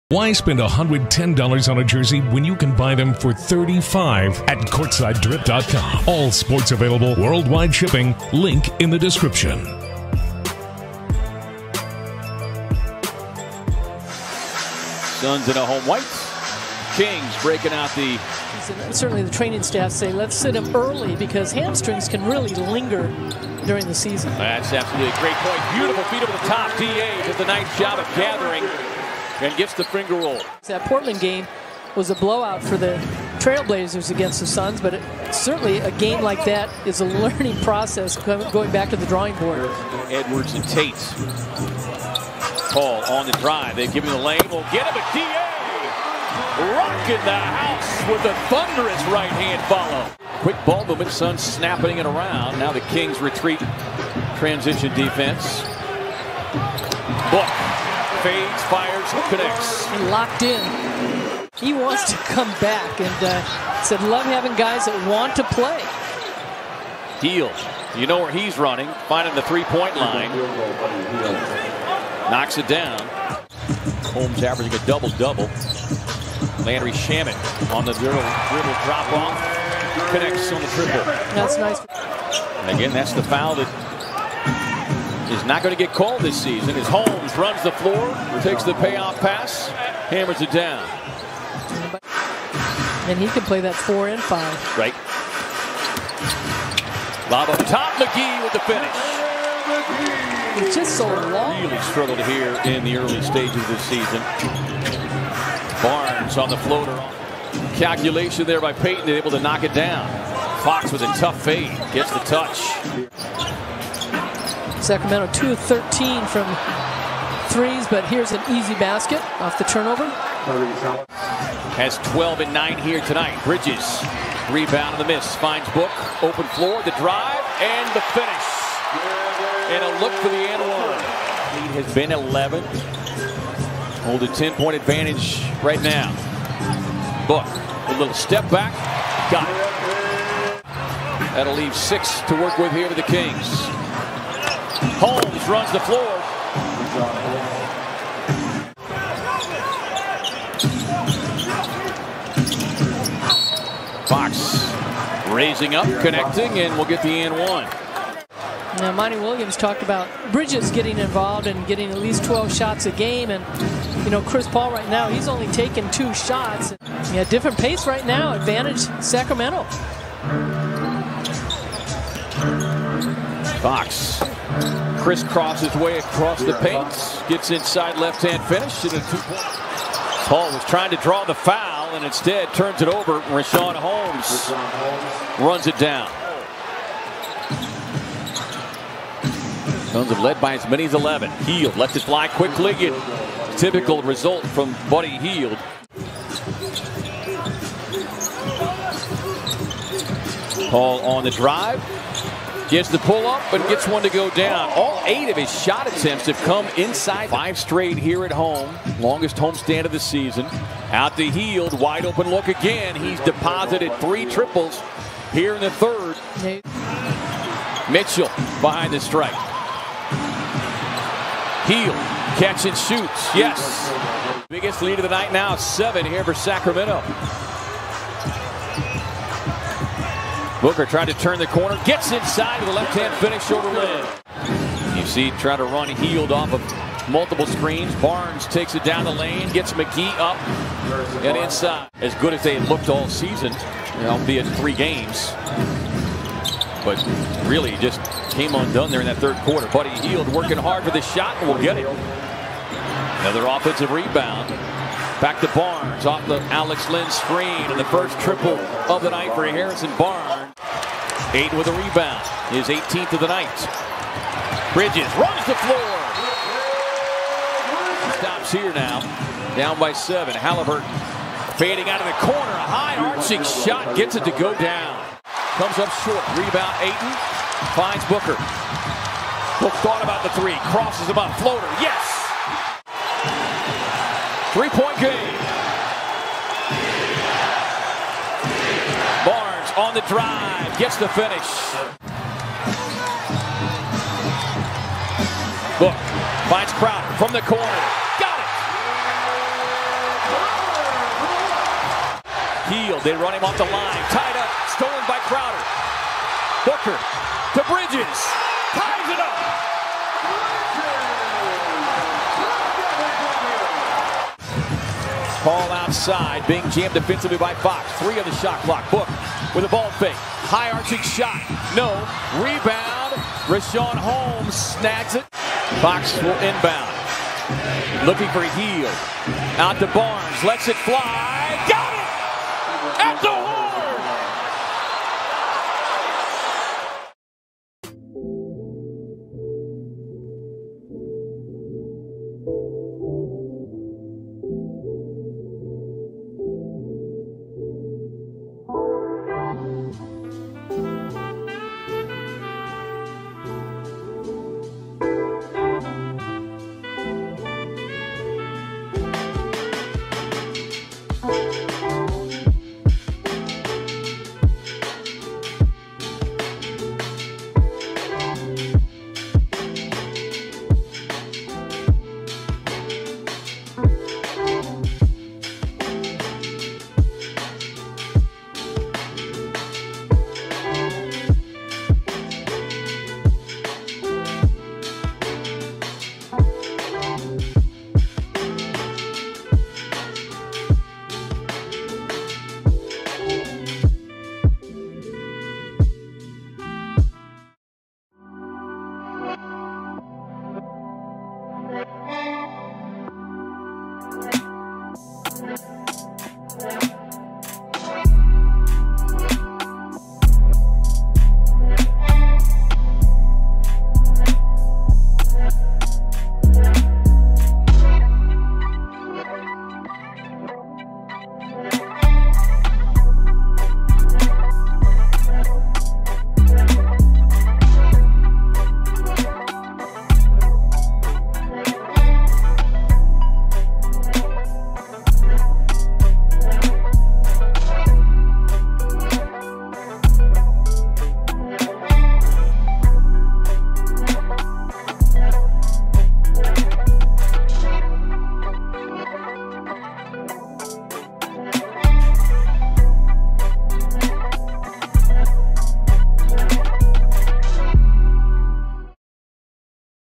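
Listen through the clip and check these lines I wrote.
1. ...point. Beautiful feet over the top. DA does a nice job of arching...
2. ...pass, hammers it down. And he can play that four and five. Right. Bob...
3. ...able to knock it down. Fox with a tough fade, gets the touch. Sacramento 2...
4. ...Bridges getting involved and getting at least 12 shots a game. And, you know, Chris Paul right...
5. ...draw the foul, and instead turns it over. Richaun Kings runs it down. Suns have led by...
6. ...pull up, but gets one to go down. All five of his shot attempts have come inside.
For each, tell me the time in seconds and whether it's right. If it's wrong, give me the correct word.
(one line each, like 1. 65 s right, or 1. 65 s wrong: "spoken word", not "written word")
1. 25 s wrong: "gathering", not "arching"
2. 89 s right
3. 109 s right
4. 160 s right
5. 180 s wrong: "Holmes", not "Kings"
6. 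202 s wrong: "eight", not "five".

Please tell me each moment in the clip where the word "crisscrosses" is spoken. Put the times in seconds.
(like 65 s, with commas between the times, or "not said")
175 s.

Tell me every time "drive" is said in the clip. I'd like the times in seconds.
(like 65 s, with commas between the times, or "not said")
43 s, 126 s, 201 s, 290 s.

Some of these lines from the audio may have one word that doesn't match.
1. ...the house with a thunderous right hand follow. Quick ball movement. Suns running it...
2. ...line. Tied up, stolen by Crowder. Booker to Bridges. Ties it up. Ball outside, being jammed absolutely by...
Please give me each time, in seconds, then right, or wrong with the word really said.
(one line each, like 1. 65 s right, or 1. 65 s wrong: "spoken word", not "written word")
1. 47 s wrong: "snapping", not "running"
2. 303 s wrong: "defensively", not "absolutely".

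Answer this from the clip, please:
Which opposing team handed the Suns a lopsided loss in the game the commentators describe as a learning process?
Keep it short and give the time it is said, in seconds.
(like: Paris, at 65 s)
Trailblazers, at 33 s.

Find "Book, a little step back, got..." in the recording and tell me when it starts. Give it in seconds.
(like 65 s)
137 s.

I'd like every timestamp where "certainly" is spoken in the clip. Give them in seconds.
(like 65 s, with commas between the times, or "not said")
18 s, 35 s.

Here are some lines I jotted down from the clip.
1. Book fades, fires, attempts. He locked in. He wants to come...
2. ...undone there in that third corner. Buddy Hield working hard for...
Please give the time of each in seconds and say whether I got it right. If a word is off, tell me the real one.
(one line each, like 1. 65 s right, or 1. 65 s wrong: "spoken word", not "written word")
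1. 57 s wrong: "connects", not "attempts"
2. 248 s wrong: "quarter", not "corner".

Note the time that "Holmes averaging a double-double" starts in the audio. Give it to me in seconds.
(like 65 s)
74 s.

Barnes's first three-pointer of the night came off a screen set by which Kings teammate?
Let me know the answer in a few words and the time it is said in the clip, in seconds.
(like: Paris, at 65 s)
Alex Len, at 256 s.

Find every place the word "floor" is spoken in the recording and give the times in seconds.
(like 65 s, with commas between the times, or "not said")
87 s, 126 s, 145 s, 265 s.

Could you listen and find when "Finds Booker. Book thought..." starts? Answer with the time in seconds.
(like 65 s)
277 s.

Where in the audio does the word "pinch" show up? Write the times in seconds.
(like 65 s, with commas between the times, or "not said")
not said.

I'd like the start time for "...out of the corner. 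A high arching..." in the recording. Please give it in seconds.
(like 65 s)
271 s.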